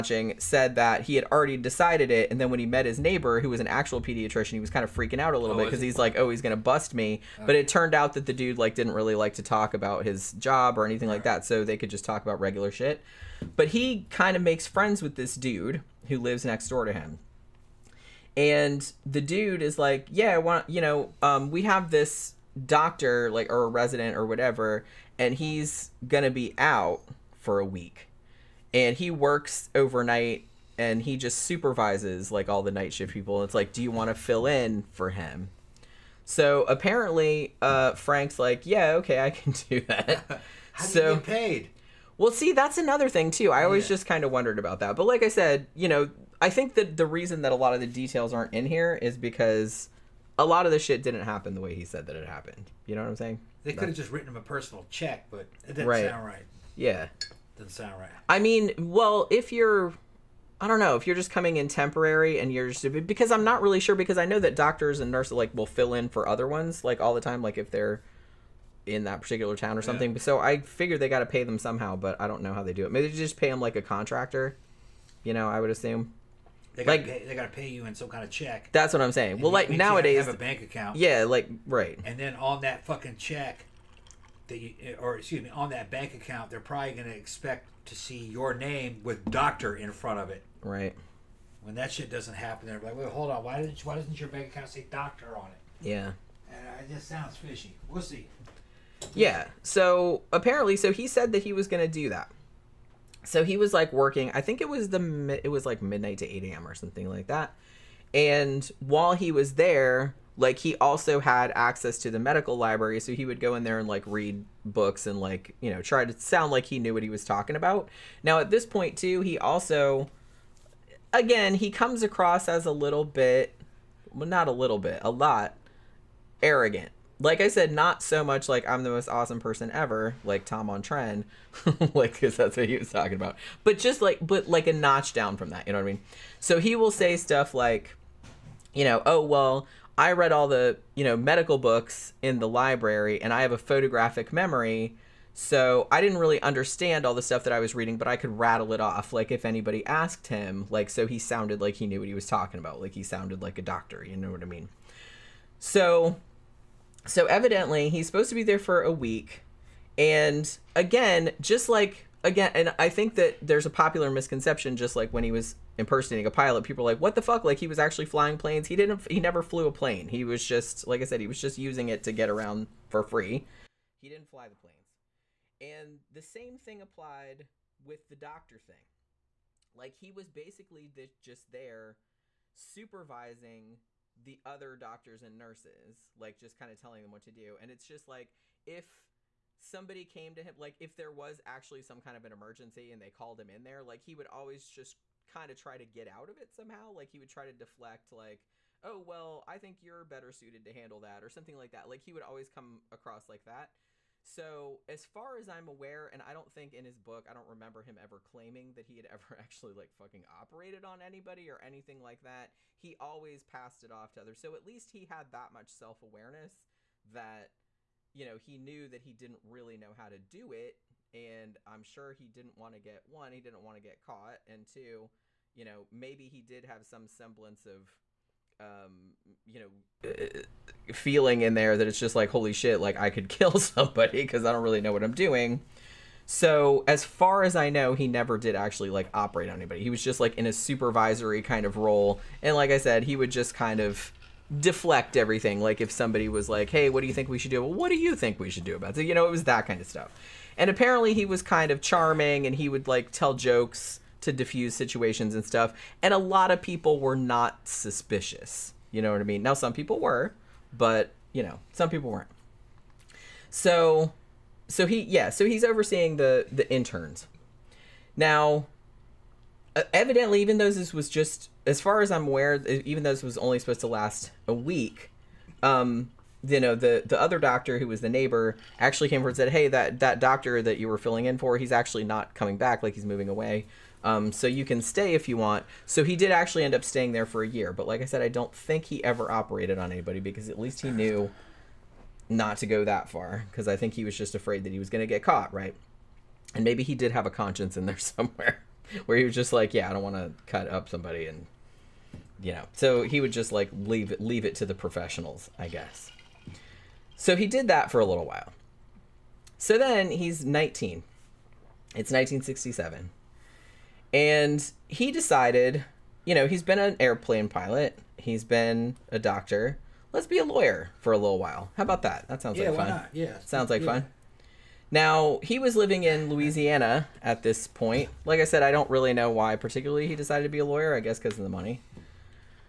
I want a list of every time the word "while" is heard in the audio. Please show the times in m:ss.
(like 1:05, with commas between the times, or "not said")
1:48, 5:08, 5:21.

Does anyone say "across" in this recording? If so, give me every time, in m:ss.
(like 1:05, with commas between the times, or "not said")
2:02, 3:22.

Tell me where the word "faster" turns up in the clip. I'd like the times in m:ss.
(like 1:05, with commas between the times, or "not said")
not said.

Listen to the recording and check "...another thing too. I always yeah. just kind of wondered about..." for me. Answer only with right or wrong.
right.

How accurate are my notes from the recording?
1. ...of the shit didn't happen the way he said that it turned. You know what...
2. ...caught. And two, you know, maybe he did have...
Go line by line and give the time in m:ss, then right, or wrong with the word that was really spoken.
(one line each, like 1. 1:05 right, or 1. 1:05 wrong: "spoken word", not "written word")
1. 0:50 wrong: "happened", not "turned"
2. 3:44 right.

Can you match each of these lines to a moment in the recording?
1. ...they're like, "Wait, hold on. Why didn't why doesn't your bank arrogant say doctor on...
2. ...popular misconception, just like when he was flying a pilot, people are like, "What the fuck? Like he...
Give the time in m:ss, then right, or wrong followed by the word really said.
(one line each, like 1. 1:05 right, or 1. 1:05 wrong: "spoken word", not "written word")
1. 1:32 wrong: "account", not "arrogant"
2. 2:43 wrong: "impersonating", not "flying".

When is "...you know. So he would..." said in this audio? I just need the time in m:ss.
5:02.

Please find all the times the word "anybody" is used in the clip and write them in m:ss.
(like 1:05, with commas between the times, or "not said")
2:29, 3:31, 3:59, 4:49.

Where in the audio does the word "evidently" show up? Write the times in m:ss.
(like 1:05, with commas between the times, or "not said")
2:37, 4:29.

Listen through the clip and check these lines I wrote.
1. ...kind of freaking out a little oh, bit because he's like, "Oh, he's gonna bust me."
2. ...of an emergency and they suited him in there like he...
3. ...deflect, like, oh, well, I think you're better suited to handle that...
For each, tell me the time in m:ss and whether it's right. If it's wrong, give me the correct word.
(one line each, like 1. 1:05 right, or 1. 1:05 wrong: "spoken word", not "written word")
1. 0:04 right
2. 3:12 wrong: "called", not "suited"
3. 3:17 right.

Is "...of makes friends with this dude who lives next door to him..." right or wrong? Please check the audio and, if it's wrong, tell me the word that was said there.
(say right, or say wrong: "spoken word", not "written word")
right.